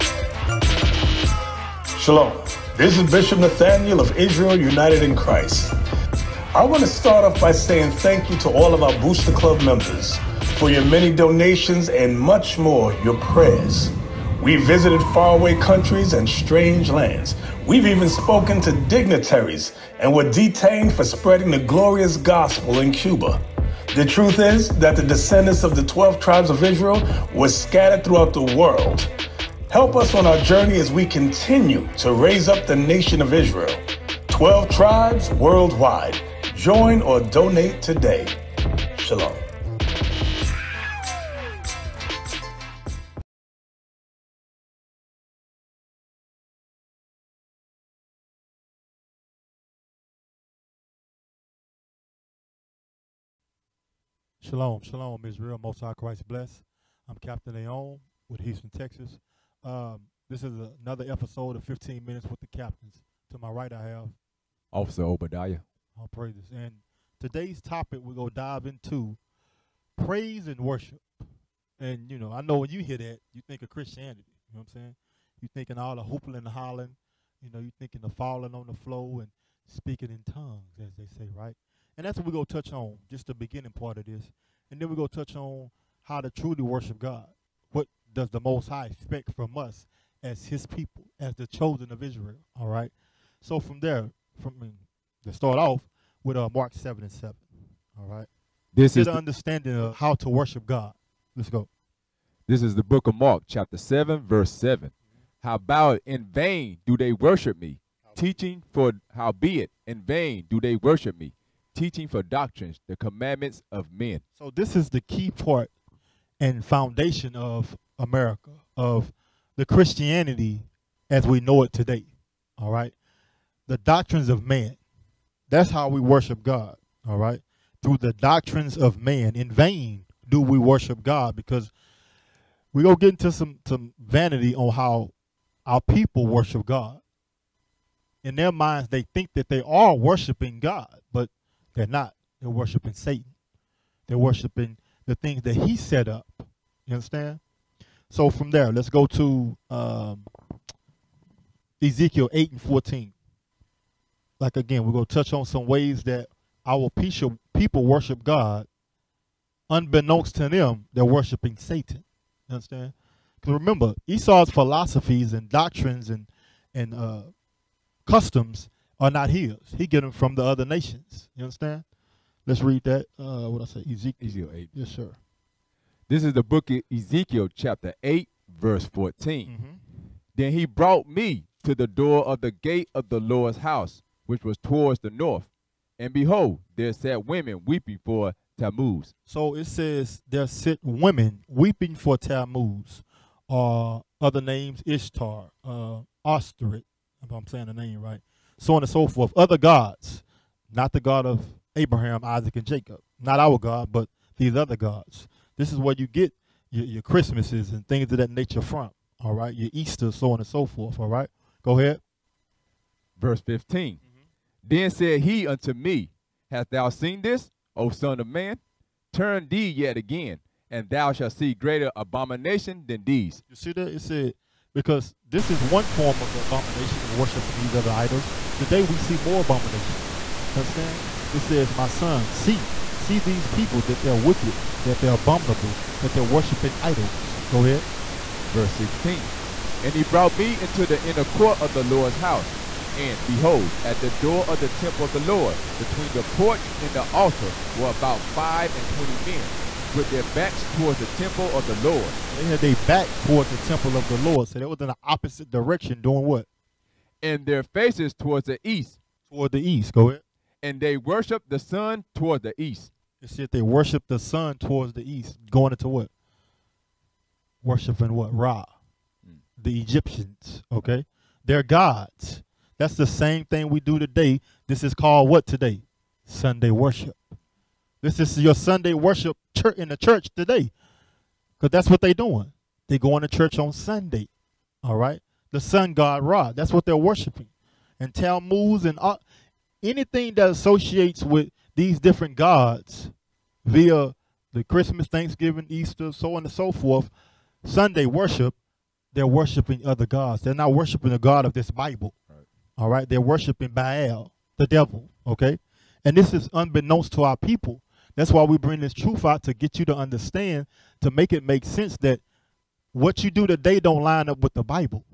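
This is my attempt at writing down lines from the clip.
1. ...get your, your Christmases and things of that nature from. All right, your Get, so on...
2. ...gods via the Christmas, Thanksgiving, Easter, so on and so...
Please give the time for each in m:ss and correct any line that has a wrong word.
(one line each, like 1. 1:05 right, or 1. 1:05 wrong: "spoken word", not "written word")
1. 3:26 wrong: "Easter", not "Get"
2. 4:52 right.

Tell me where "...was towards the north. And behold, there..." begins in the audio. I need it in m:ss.
3:04.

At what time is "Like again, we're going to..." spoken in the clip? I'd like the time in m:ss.
2:34.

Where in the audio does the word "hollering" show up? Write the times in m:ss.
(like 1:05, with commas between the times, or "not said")
1:16.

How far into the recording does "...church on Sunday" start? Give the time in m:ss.
4:43.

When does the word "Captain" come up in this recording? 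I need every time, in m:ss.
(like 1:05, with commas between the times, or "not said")
0:57, 1:02.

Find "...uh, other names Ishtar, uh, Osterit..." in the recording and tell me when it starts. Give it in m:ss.
3:14.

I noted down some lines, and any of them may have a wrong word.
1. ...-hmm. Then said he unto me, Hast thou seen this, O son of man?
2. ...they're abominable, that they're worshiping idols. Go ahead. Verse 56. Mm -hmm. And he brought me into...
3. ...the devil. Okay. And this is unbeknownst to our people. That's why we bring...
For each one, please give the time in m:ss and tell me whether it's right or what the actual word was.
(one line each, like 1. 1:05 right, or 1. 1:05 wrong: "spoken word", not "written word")
1. 3:33 right
2. 3:55 wrong: "16", not "56"
3. 5:04 right.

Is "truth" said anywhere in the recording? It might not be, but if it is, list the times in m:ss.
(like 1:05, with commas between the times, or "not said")
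0:24, 5:08.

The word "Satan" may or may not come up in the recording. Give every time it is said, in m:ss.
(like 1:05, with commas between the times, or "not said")
2:22, 2:41.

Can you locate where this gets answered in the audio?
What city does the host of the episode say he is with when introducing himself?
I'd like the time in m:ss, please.
0:58.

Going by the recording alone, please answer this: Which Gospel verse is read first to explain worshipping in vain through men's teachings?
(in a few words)
Mark 7:7.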